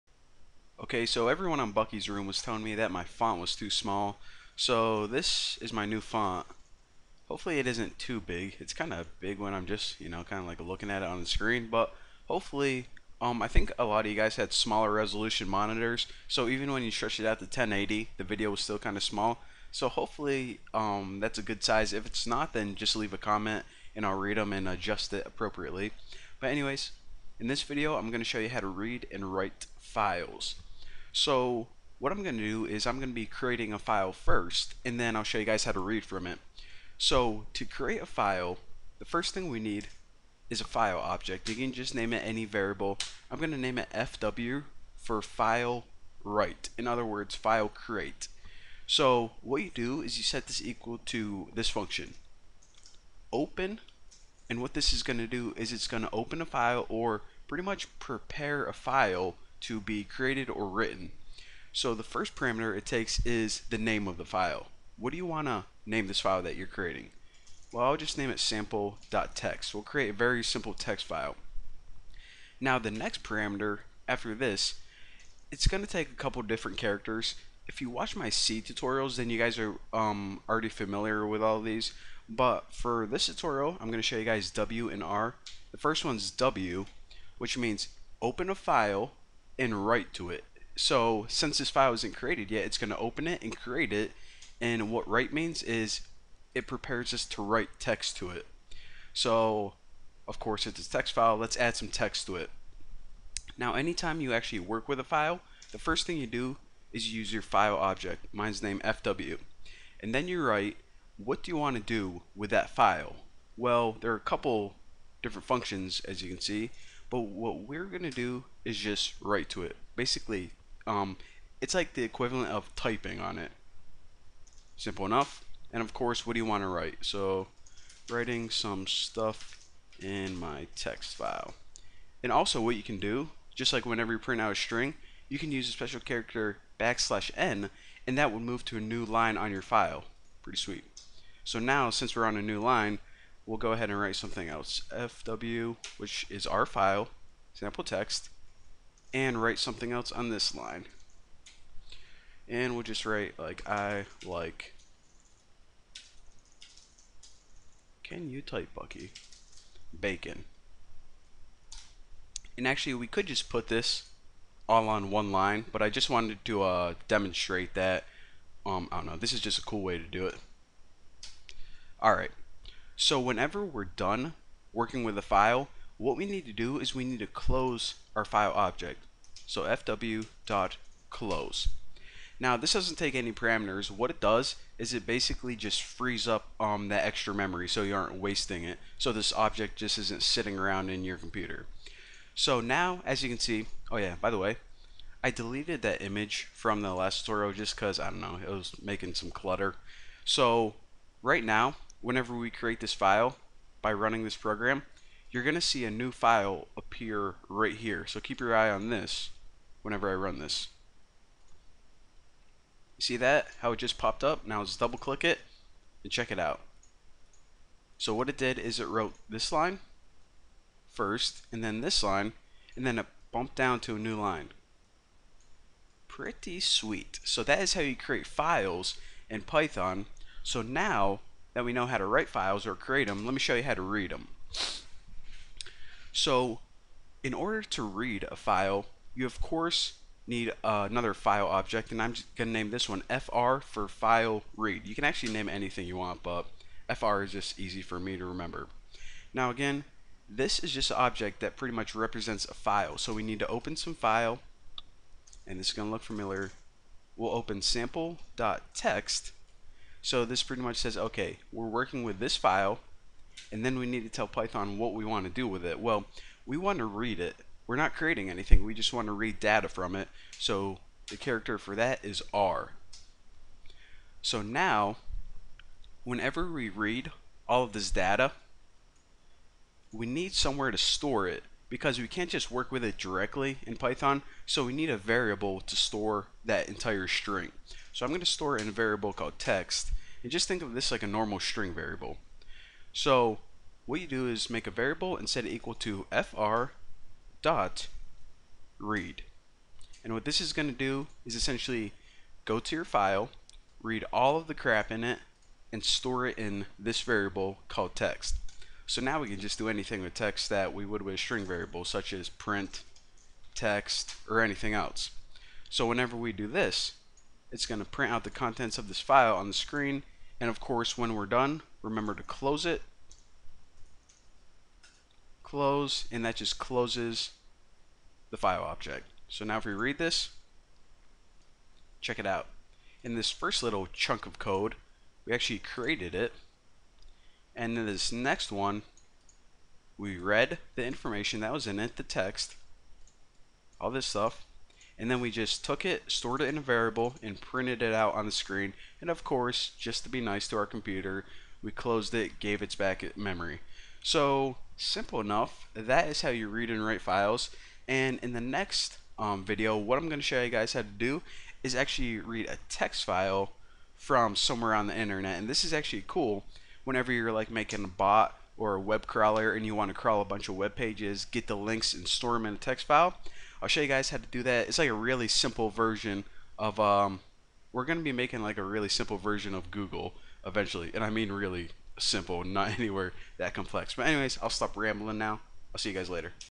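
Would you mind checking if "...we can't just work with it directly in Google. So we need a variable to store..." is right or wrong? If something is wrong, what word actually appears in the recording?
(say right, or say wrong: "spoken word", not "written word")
wrong: "Python", not "Google".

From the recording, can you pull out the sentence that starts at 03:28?
So keep your eye on this whenever I run this.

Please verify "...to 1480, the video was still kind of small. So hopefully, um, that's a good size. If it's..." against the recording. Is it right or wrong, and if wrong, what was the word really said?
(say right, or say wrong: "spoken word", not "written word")
wrong: "1080", not "1480".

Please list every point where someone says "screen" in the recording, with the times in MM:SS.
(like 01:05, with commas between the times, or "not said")
00:11, 05:19, 05:48.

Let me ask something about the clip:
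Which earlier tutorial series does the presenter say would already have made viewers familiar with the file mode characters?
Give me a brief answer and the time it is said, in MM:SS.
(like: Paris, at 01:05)
C tutorials, at 01:18.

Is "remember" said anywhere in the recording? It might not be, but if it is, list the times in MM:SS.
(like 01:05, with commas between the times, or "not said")
04:08, 05:21.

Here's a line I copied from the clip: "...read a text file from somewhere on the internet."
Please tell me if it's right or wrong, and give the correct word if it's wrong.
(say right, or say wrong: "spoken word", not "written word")
right.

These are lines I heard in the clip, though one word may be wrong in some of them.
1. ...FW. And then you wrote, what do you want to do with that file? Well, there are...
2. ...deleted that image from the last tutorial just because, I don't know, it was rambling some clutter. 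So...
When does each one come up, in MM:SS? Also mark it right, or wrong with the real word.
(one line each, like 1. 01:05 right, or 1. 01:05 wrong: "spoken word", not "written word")
1. 01:48 wrong: "write", not "wrote"
2. 03:15 wrong: "making", not "rambling".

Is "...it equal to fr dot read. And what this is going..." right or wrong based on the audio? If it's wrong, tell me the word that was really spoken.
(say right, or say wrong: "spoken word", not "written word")
right.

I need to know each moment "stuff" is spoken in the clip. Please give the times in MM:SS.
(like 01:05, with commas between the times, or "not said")
02:08, 05:44.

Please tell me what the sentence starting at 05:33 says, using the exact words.
In this first little chunk of code, we actually created it.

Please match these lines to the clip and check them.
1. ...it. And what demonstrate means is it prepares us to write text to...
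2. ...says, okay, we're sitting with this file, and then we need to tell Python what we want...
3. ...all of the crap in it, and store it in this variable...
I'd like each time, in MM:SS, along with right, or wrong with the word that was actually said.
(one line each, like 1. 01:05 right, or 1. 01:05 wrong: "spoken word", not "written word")
1. 01:33 wrong: "write", not "demonstrate"
2. 04:20 wrong: "working", not "sitting"
3. 05:04 right.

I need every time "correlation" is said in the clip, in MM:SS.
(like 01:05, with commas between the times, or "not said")
not said.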